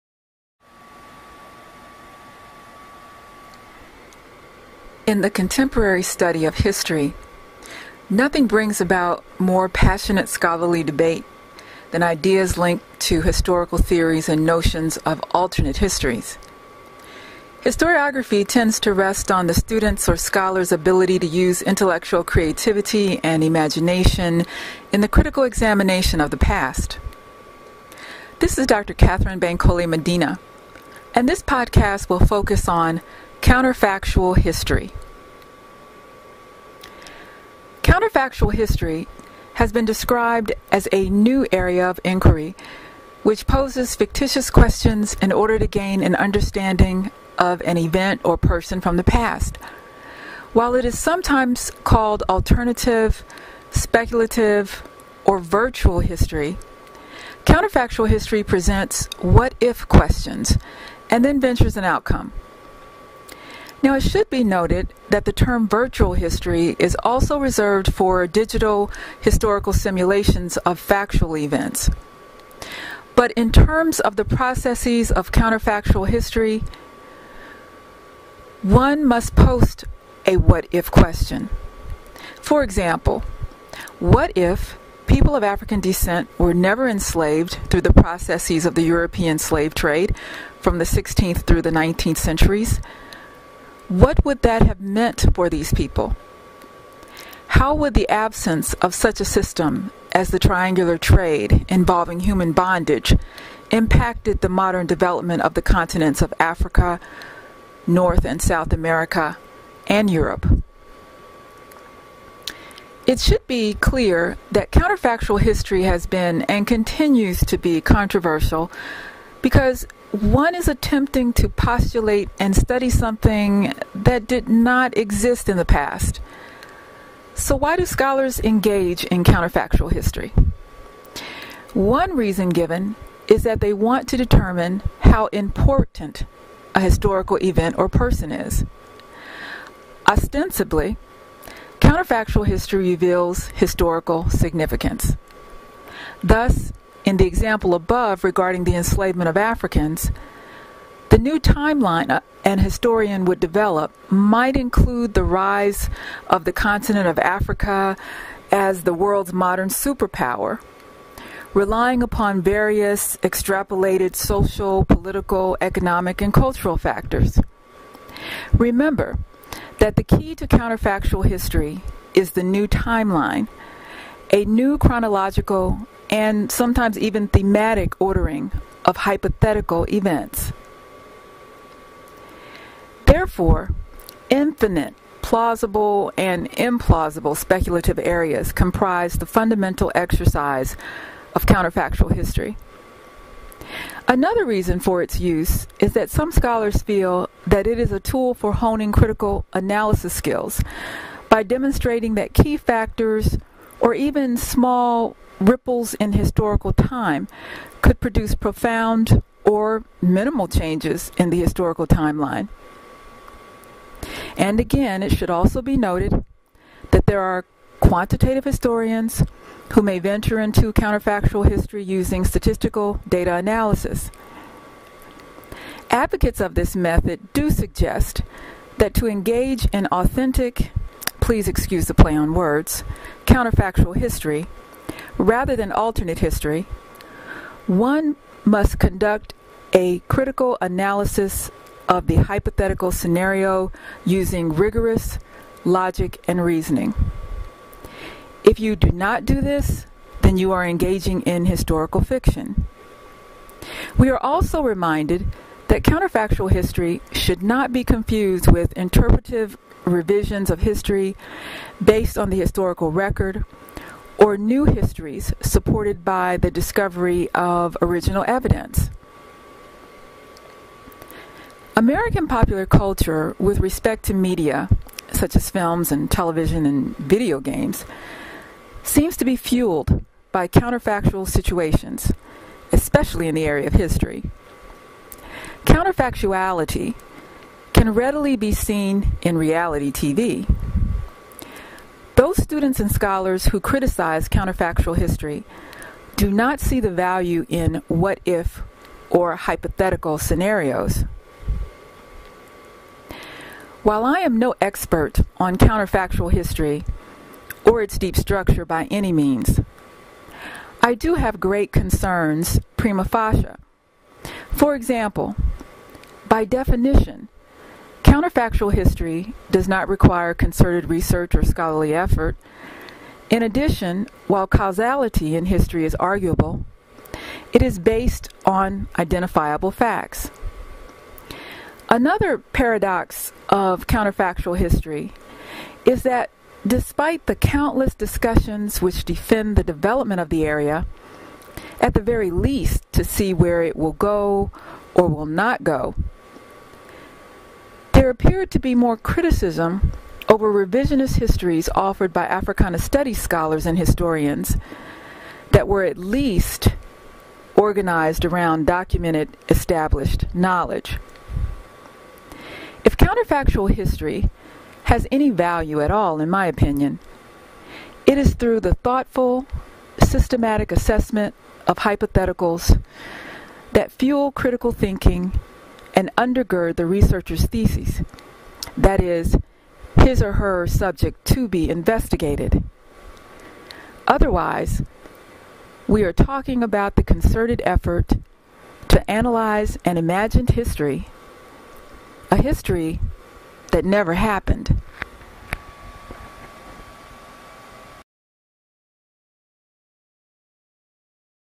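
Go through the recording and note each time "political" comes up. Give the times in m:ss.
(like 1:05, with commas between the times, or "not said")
2:44.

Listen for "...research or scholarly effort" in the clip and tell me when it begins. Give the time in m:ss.
5:20.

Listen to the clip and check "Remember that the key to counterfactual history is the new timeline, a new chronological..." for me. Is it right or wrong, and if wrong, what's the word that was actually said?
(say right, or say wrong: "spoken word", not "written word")
right.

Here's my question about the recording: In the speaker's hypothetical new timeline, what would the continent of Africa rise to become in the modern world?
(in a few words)
the world's modern superpower.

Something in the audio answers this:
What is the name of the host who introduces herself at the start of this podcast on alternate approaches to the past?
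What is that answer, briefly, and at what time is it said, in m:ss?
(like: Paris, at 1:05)
Katherine Bankole-Medina, at 0:28.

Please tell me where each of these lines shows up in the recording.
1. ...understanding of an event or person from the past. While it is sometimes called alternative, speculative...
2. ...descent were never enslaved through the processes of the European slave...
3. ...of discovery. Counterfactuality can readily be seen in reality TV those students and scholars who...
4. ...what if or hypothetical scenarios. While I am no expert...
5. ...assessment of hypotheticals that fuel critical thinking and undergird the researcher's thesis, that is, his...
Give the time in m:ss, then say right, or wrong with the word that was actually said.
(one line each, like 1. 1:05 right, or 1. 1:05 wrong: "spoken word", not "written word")
1. 0:46 right
2. 1:25 right
3. 4:43 wrong: "history", not "discovery"
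4. 4:57 right
5. 6:10 right.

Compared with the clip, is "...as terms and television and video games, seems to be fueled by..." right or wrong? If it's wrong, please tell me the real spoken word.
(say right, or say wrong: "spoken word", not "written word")
wrong: "films", not "terms".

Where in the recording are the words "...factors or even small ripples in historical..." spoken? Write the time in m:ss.
3:22.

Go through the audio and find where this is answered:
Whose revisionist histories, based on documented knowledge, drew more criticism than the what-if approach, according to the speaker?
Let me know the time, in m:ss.
5:52.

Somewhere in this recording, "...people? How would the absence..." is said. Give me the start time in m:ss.
1:35.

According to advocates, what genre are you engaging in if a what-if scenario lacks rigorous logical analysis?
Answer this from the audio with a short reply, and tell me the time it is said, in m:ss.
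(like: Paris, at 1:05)
historical fiction, at 4:11.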